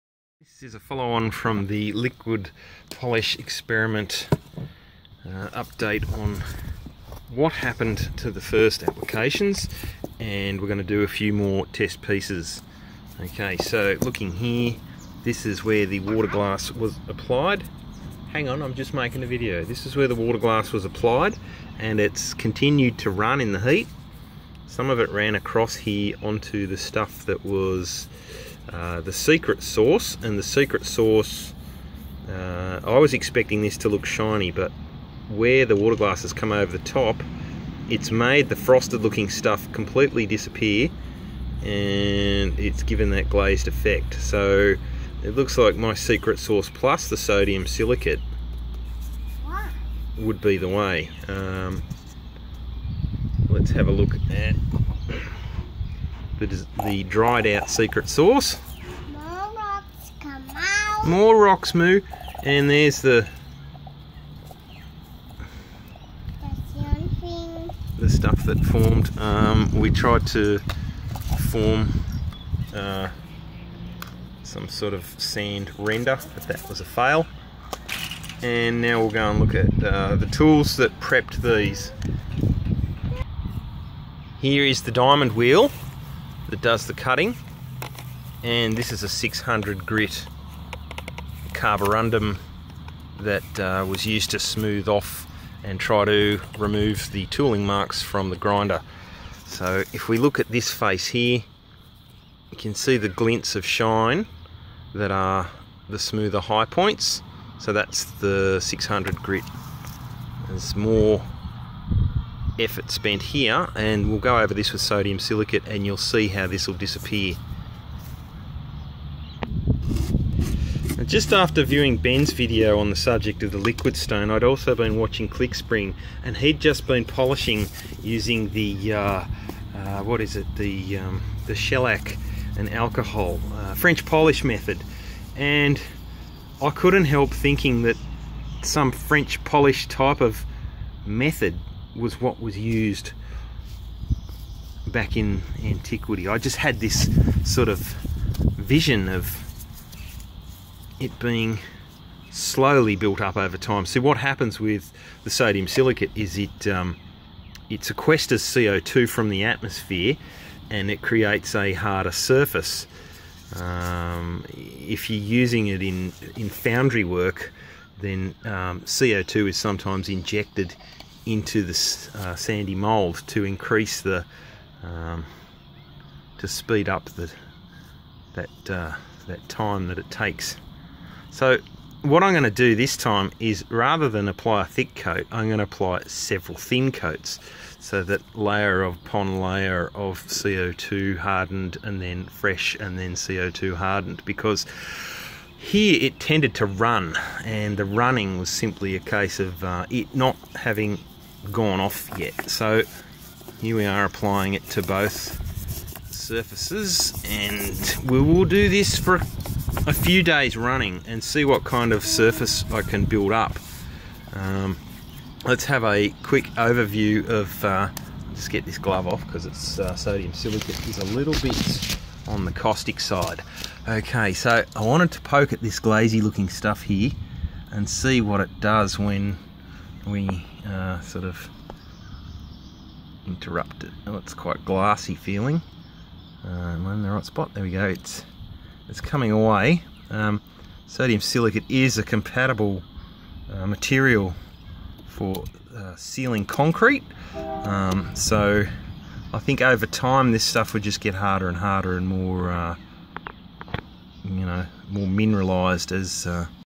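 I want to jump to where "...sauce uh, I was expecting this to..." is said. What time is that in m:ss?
0:30.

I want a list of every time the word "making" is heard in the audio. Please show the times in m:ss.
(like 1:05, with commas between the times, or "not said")
0:18.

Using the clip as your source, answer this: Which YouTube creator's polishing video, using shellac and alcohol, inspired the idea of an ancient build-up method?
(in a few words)
Clickspring.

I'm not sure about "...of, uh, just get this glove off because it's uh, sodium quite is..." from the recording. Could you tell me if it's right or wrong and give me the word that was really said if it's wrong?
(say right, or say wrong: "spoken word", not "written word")
wrong: "silicate", not "quite".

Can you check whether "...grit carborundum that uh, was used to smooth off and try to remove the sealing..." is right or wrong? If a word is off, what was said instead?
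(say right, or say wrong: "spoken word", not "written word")
wrong: "tooling", not "sealing".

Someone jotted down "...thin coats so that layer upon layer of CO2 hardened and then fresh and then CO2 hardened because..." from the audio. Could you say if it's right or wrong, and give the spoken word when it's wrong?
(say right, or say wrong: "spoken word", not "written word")
right.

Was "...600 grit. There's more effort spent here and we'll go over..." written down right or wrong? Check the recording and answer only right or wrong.
right.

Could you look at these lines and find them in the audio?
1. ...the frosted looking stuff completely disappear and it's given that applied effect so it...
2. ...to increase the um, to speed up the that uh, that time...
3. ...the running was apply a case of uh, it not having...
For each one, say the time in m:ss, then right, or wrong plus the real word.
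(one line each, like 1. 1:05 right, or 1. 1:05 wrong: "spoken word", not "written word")
1. 0:38 wrong: "glazed", not "applied"
2. 2:53 right
3. 3:17 wrong: "simply", not "apply".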